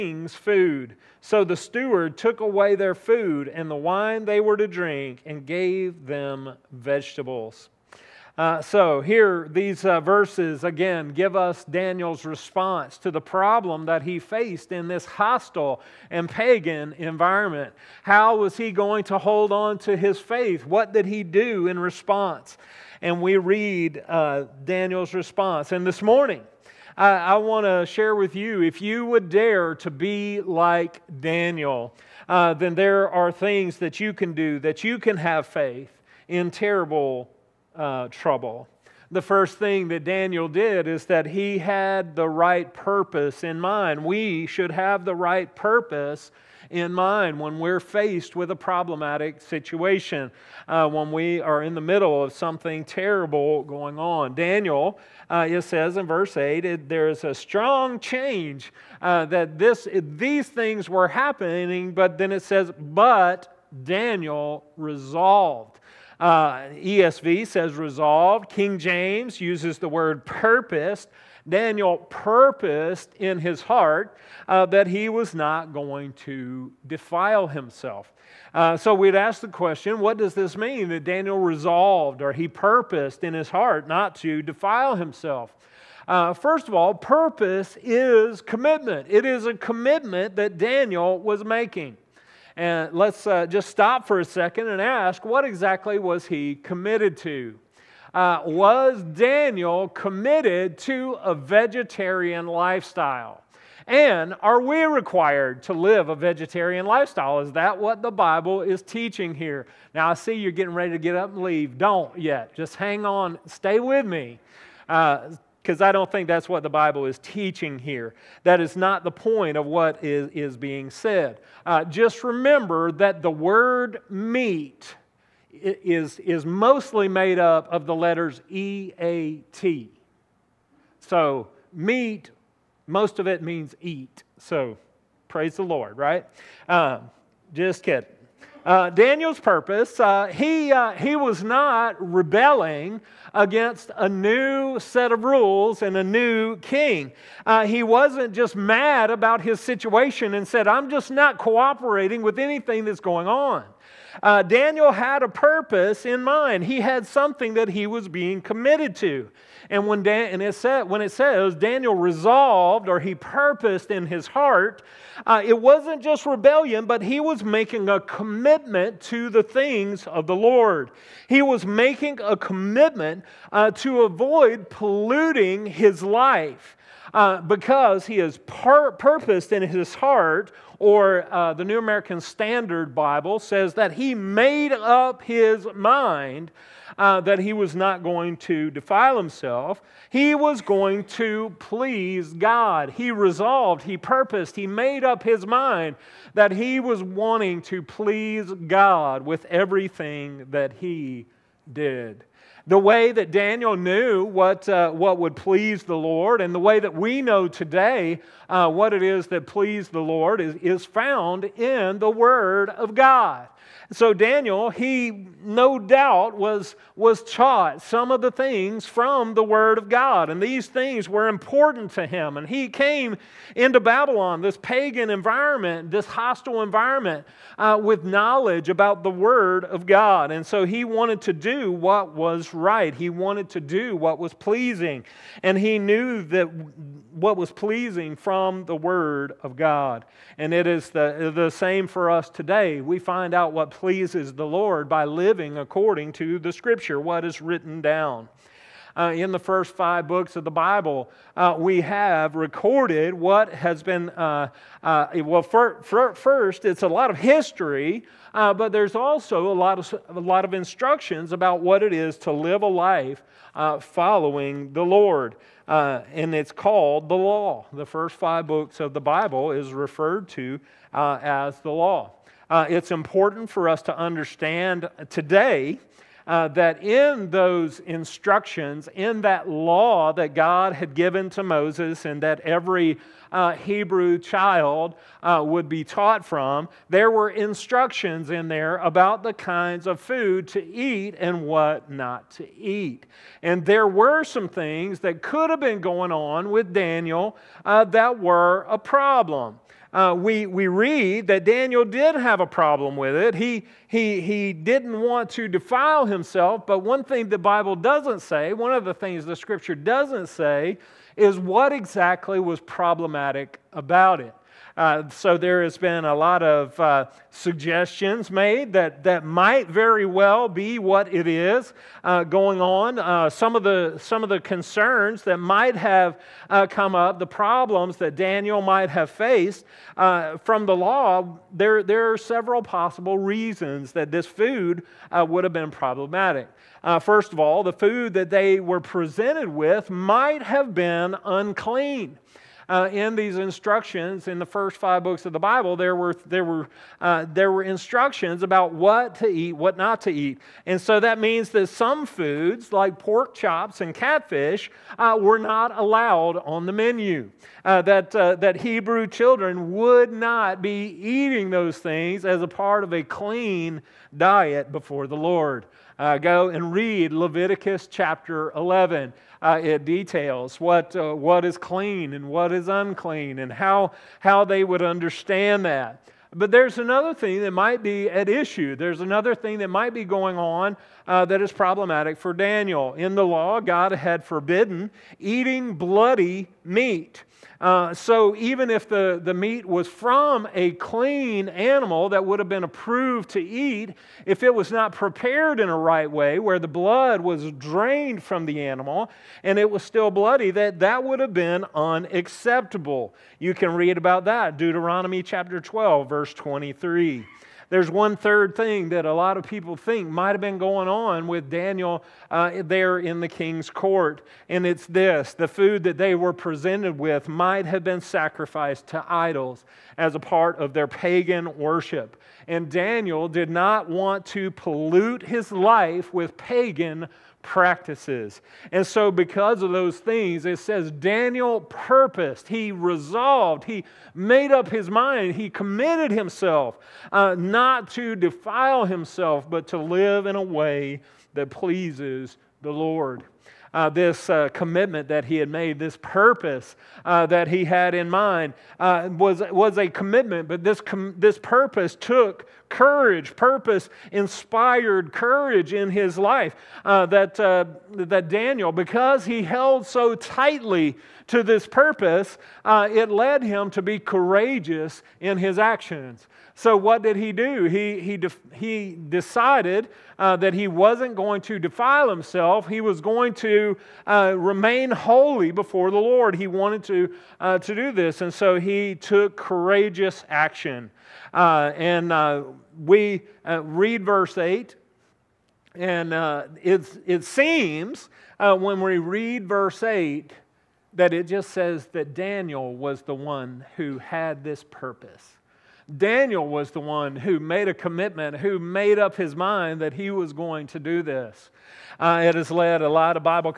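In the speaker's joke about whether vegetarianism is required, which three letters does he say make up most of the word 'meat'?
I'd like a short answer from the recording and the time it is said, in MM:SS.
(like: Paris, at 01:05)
E A T, at 02:08.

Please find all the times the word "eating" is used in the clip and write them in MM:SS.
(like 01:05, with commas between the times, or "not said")
06:00, 06:25.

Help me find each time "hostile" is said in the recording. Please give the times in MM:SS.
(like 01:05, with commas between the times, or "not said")
00:15, 03:46.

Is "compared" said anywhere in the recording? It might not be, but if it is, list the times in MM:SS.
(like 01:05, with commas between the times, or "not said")
not said.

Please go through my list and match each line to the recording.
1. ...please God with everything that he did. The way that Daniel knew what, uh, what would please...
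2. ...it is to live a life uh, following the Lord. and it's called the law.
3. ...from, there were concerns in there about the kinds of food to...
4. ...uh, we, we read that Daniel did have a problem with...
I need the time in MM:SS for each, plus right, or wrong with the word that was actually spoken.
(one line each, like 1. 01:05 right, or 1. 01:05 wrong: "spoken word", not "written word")
1. 03:17 right
2. 04:21 right
3. 04:46 wrong: "instructions", not "concerns"
4. 04:59 right.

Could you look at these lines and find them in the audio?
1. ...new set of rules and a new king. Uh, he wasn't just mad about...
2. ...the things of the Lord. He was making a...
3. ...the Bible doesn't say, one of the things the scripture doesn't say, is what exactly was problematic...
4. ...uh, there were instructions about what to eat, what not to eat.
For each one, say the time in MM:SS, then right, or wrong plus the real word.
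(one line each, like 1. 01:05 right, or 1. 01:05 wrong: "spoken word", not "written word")
1. 02:24 right
2. 02:49 right
3. 05:07 right
4. 05:46 right.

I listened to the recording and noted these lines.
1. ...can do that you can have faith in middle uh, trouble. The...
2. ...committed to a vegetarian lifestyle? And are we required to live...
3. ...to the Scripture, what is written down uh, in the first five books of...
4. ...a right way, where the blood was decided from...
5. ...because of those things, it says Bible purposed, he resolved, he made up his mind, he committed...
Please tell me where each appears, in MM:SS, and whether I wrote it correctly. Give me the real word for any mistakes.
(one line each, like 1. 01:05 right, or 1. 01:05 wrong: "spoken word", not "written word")
1. 00:34 wrong: "terrible", not "middle"
2. 01:39 right
3. 04:06 right
4. 06:35 wrong: "drained", not "decided"
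5. 07:09 wrong: "Daniel", not "Bible".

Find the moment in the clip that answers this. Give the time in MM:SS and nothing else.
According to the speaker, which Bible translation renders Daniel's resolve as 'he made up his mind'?
03:01.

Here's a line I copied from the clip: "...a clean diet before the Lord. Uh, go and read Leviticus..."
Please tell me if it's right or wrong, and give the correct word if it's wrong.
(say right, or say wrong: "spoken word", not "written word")
right.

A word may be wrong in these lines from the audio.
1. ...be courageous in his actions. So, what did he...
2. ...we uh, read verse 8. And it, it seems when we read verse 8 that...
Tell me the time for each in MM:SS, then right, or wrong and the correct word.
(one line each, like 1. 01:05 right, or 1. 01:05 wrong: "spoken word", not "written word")
1. 07:43 right
2. 08:02 right.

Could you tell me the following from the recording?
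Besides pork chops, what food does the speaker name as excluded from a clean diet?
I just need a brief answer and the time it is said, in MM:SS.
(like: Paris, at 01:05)
catfish, at 05:53.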